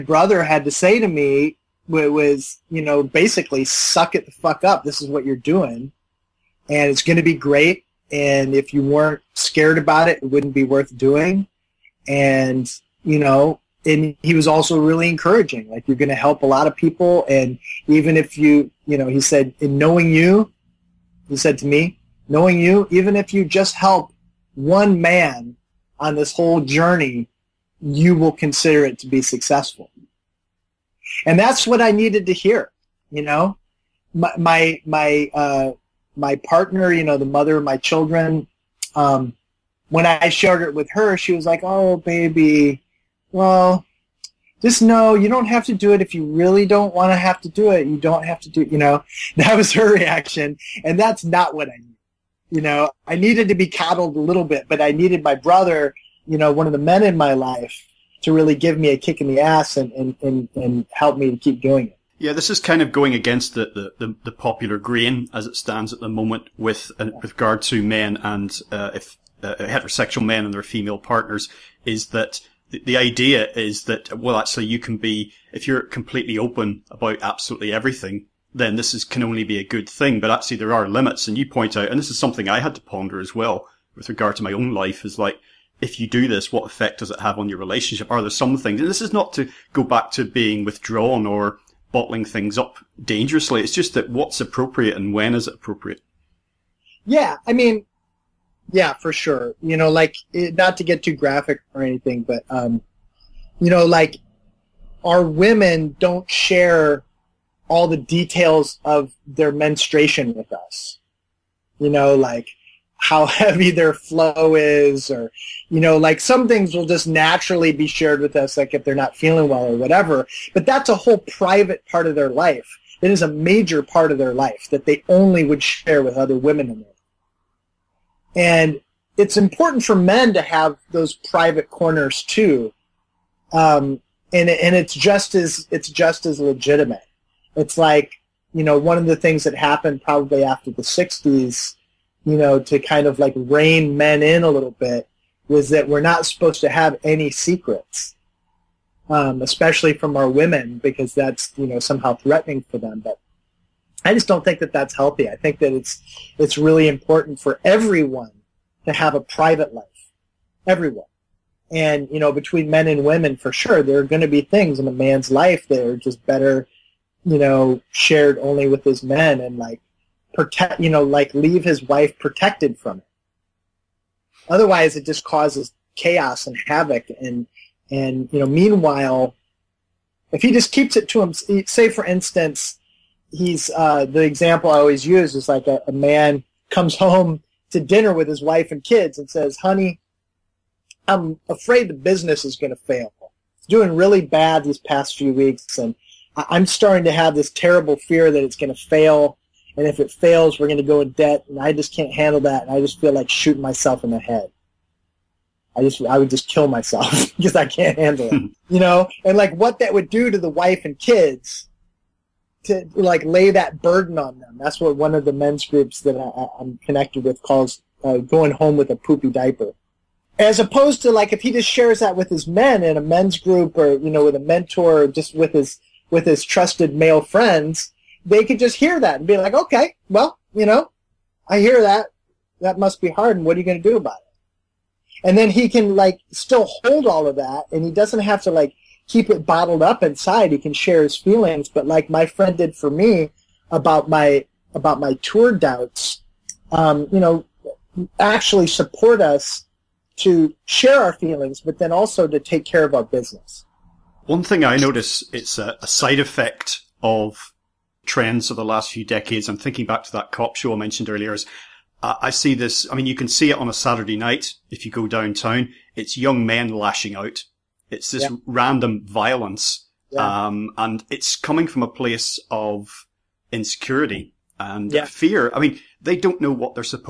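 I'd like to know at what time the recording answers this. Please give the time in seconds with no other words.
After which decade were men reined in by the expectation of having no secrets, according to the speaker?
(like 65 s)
140 s.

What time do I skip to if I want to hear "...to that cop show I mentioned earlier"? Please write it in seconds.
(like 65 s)
260 s.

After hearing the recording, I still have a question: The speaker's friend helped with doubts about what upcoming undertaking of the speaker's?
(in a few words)
tour.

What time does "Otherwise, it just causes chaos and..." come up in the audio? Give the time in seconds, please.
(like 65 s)
174 s.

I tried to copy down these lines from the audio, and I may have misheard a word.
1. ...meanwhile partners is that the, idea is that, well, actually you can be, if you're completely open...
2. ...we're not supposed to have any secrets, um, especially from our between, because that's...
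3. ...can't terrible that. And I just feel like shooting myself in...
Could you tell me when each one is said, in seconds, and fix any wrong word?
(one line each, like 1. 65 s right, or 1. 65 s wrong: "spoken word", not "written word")
1. 70 s wrong: "female", not "meanwhile"
2. 145 s wrong: "women", not "between"
3. 201 s wrong: "handle", not "terrible".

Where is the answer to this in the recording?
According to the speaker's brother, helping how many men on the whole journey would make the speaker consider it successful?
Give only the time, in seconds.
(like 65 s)
24 s.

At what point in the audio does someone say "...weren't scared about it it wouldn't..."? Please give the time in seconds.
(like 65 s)
8 s.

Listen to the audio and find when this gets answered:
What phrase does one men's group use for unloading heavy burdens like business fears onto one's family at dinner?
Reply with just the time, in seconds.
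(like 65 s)
218 s.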